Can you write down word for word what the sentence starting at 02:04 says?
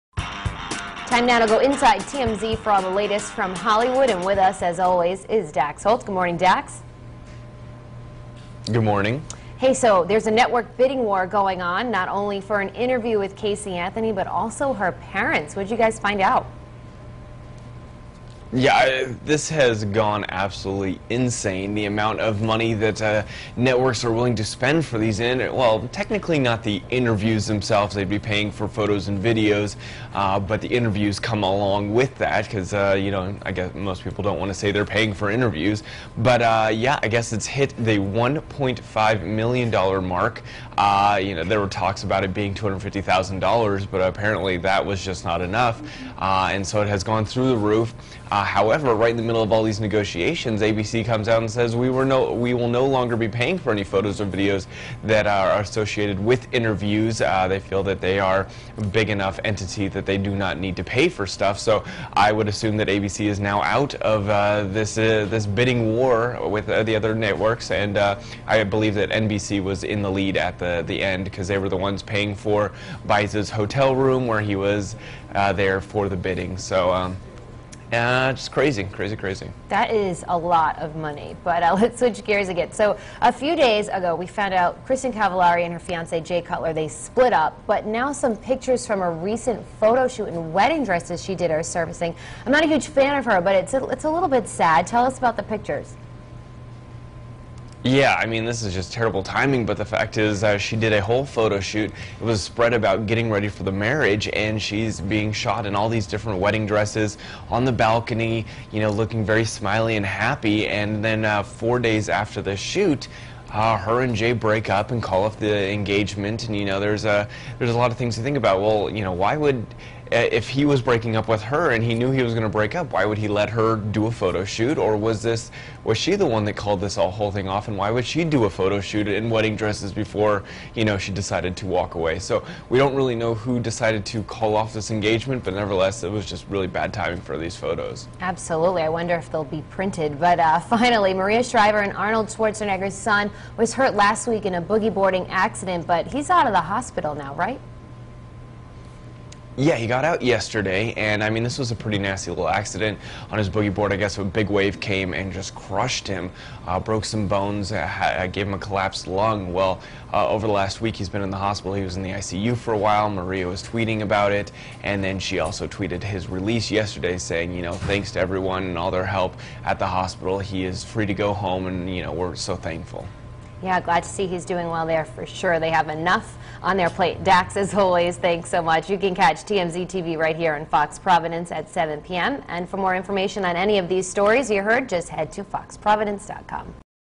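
Or was this was she the one that called this all whole thing off?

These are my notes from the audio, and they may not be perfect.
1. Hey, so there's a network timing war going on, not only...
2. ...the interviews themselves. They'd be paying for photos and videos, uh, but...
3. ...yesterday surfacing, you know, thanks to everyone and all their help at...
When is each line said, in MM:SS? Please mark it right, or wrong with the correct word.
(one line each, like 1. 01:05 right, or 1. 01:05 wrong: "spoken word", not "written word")
1. 00:09 wrong: "bidding", not "timing"
2. 00:26 right
3. 02:46 wrong: "saying", not "surfacing".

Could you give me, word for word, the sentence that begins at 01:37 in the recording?
Yeah, I mean, this is just terrible timing, but the fact is uh, she did a whole photo shoot.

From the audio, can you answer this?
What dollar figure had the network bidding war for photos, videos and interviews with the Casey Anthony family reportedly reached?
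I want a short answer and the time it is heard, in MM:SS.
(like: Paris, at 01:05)
$1.5 million, at 00:37.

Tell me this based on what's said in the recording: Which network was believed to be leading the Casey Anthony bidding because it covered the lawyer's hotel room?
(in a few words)
NBC.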